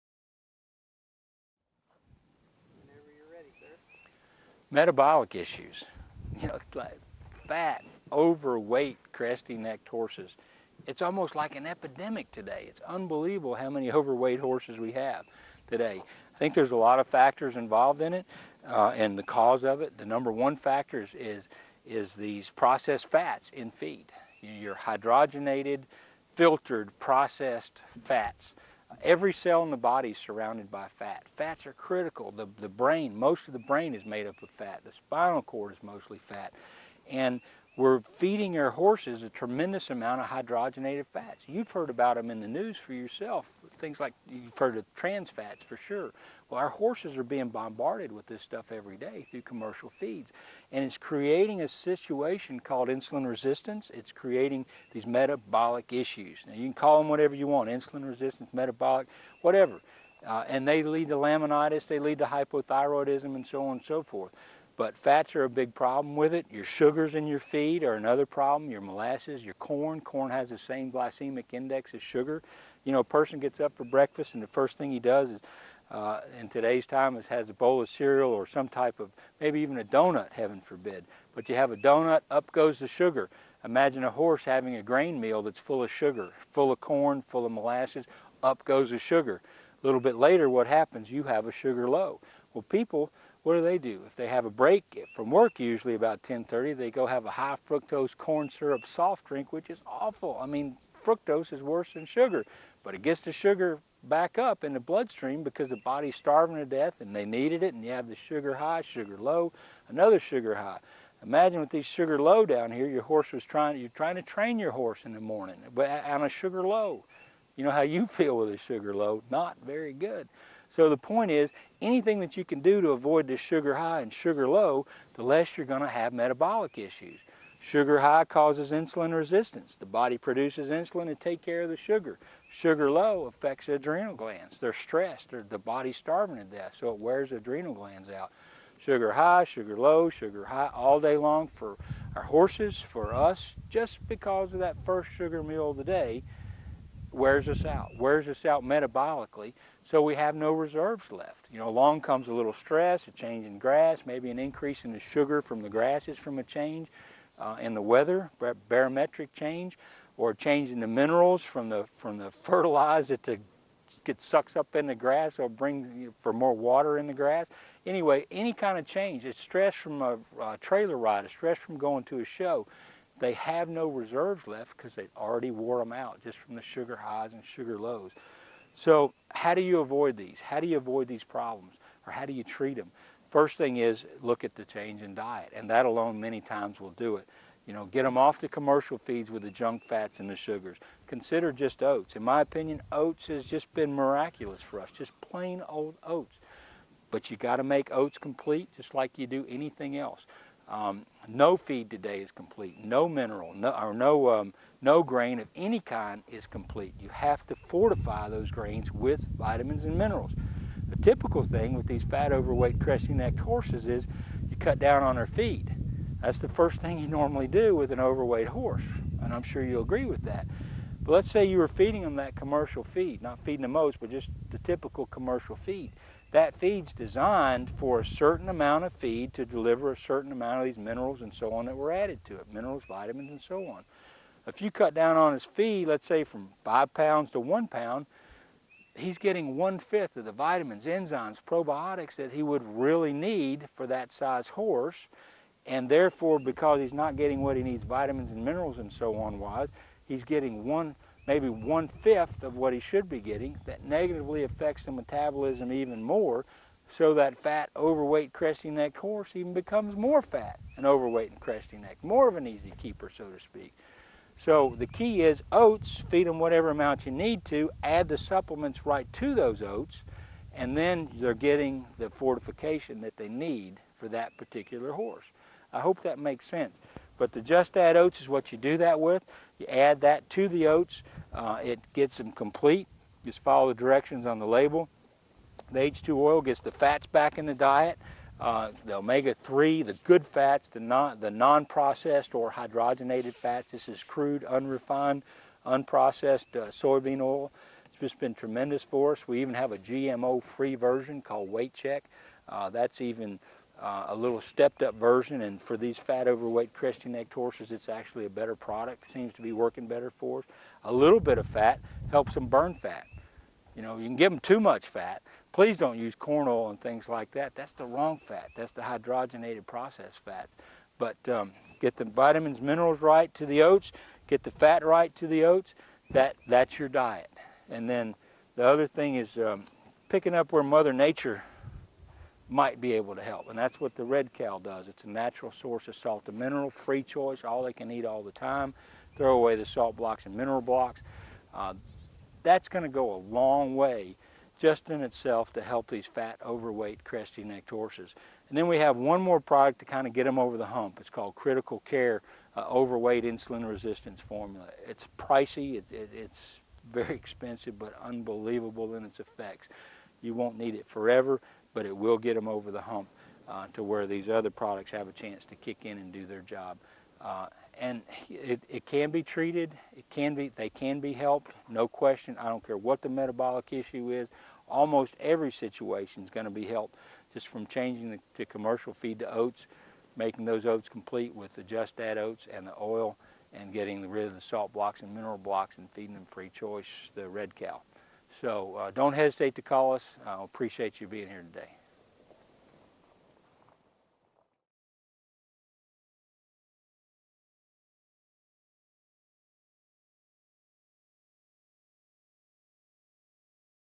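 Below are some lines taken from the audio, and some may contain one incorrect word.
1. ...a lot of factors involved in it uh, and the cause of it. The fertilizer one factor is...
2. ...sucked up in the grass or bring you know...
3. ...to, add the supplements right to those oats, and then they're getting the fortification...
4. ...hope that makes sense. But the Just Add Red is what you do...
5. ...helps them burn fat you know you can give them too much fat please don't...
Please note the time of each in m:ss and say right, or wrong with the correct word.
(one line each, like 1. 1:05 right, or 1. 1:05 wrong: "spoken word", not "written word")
1. 0:16 wrong: "number", not "fertilizer"
2. 2:44 right
3. 4:27 right
4. 4:35 wrong: "Oats", not "Red"
5. 5:12 right.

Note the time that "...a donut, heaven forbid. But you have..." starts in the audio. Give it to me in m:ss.
1:19.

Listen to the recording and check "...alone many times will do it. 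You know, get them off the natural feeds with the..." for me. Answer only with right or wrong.
wrong.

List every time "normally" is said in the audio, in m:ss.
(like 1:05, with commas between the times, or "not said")
3:37.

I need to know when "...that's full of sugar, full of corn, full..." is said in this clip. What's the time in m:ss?
1:25.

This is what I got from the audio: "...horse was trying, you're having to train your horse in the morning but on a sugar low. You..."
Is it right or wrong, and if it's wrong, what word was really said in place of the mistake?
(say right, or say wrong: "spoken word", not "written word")
wrong: "trying", not "having".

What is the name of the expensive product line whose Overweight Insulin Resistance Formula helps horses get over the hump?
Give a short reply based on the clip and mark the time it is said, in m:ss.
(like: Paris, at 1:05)
Critical Care, at 5:51.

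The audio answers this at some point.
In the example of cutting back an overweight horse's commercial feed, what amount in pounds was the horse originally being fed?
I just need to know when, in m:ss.
3:56.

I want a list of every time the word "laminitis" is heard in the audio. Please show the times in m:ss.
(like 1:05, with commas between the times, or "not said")
1:01.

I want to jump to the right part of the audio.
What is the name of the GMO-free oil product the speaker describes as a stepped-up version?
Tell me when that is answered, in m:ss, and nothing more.
5:01.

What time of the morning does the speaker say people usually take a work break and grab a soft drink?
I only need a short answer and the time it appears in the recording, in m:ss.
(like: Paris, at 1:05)
10:30, at 1:36.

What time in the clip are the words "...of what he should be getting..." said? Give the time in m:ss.
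4:12.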